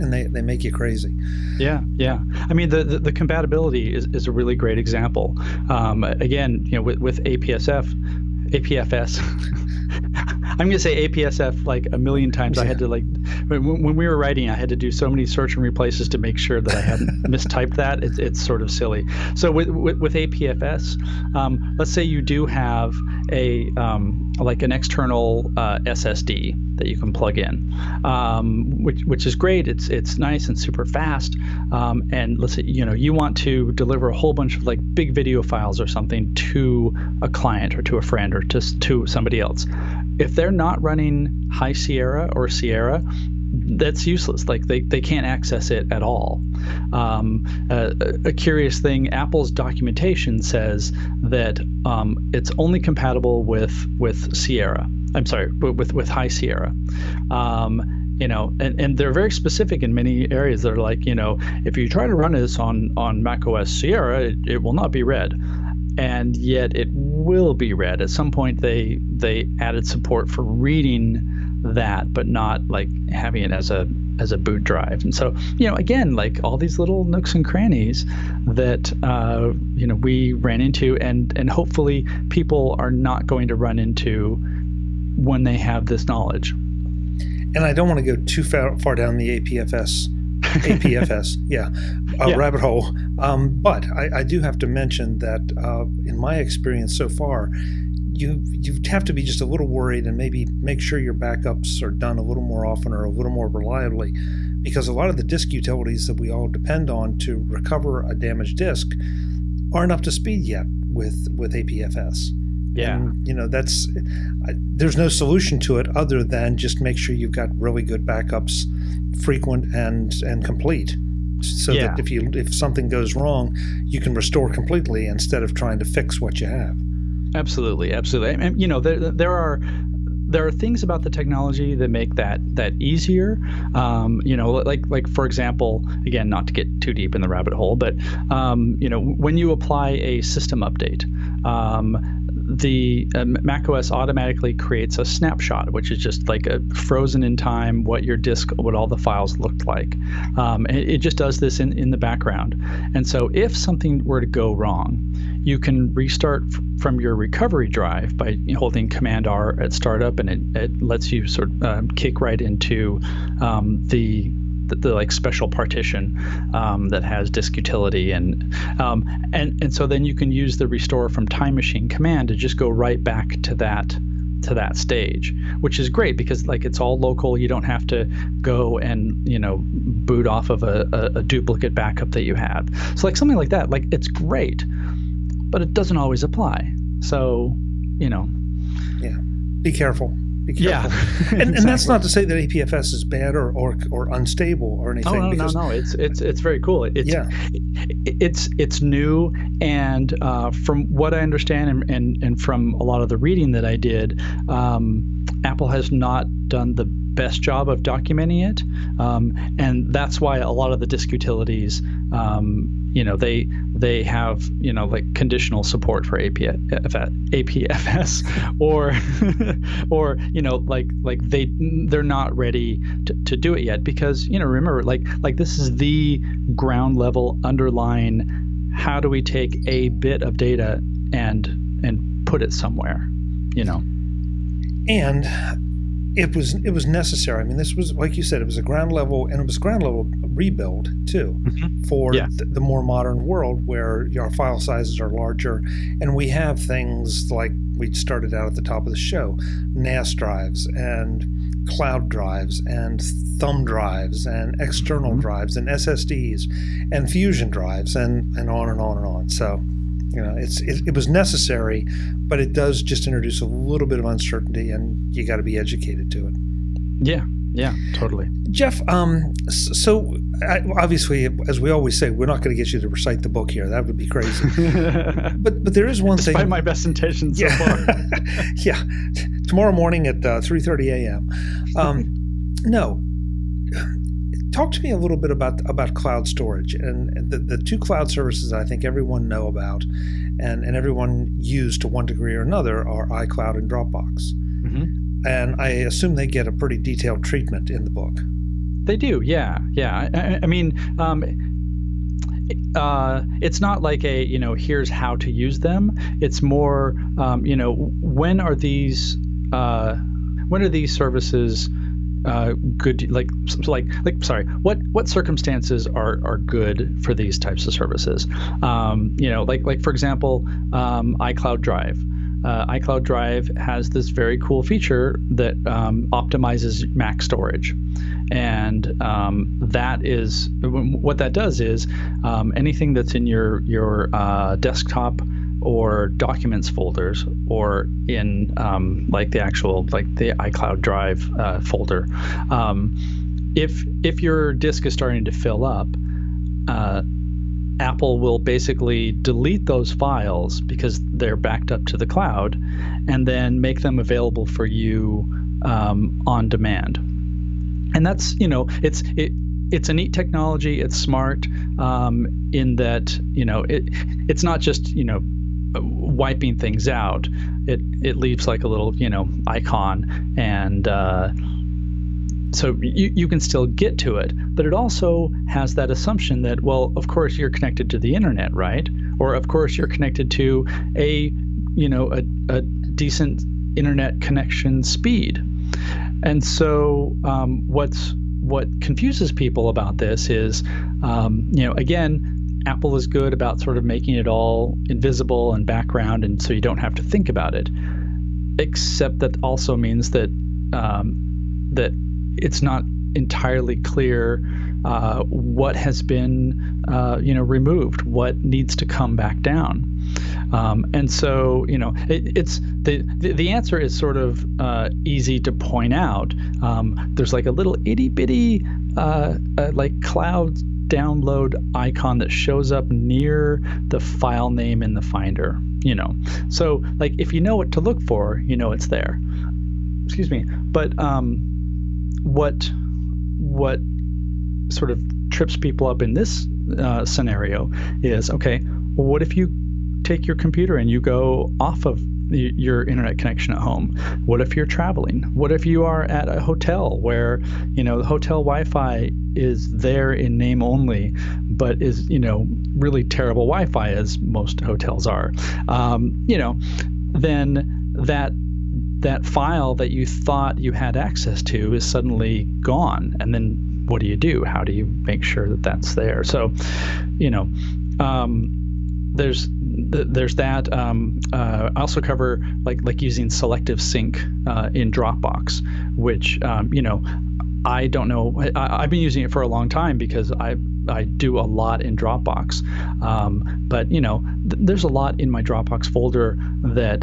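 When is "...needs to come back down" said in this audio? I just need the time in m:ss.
6:48.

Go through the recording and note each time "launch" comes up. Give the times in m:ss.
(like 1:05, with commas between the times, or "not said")
not said.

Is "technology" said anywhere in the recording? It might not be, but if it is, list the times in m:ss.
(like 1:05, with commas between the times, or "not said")
2:11, 6:00.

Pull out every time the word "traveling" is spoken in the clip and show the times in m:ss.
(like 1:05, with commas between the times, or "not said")
7:24.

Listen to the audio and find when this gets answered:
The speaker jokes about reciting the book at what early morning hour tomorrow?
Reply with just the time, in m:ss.
4:40.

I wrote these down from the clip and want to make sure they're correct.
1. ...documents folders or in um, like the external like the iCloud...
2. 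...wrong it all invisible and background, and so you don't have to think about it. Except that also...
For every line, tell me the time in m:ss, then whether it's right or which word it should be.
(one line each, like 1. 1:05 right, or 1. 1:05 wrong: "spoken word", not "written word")
1. 5:36 wrong: "actual", not "external"
2. 6:33 wrong: "making", not "wrong".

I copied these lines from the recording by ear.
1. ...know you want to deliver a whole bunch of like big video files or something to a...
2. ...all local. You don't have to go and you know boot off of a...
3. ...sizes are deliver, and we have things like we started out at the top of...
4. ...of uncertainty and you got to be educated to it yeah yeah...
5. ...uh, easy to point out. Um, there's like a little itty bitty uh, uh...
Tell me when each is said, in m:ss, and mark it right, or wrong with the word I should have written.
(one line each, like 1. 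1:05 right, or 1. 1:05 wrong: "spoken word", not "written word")
1. 0:32 right
2. 2:56 right
3. 4:04 wrong: "larger", not "deliver"
4. 4:23 right
5. 6:54 right.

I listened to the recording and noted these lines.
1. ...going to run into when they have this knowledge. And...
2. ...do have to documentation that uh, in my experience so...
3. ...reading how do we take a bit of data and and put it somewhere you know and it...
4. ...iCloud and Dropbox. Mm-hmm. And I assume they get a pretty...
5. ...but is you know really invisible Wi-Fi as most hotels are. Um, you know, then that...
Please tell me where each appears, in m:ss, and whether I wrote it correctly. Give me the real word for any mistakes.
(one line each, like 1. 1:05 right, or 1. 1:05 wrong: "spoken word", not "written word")
1. 1:23 right
2. 1:34 wrong: "mention", not "documentation"
3. 3:47 wrong: "underlying", not "reading"
4. 4:53 right
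5. 7:31 wrong: "terrible", not "invisible".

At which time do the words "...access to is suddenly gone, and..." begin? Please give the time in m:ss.
7:40.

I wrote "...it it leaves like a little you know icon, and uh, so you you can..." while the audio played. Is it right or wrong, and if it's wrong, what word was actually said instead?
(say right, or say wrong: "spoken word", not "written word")
right.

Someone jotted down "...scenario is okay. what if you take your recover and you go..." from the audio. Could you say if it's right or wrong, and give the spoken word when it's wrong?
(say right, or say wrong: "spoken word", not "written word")
wrong: "computer", not "recover".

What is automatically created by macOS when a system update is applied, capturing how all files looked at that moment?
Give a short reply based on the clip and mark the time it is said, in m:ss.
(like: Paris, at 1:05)
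a snapshot, at 2:25.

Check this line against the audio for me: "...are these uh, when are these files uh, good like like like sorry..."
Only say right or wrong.
wrong.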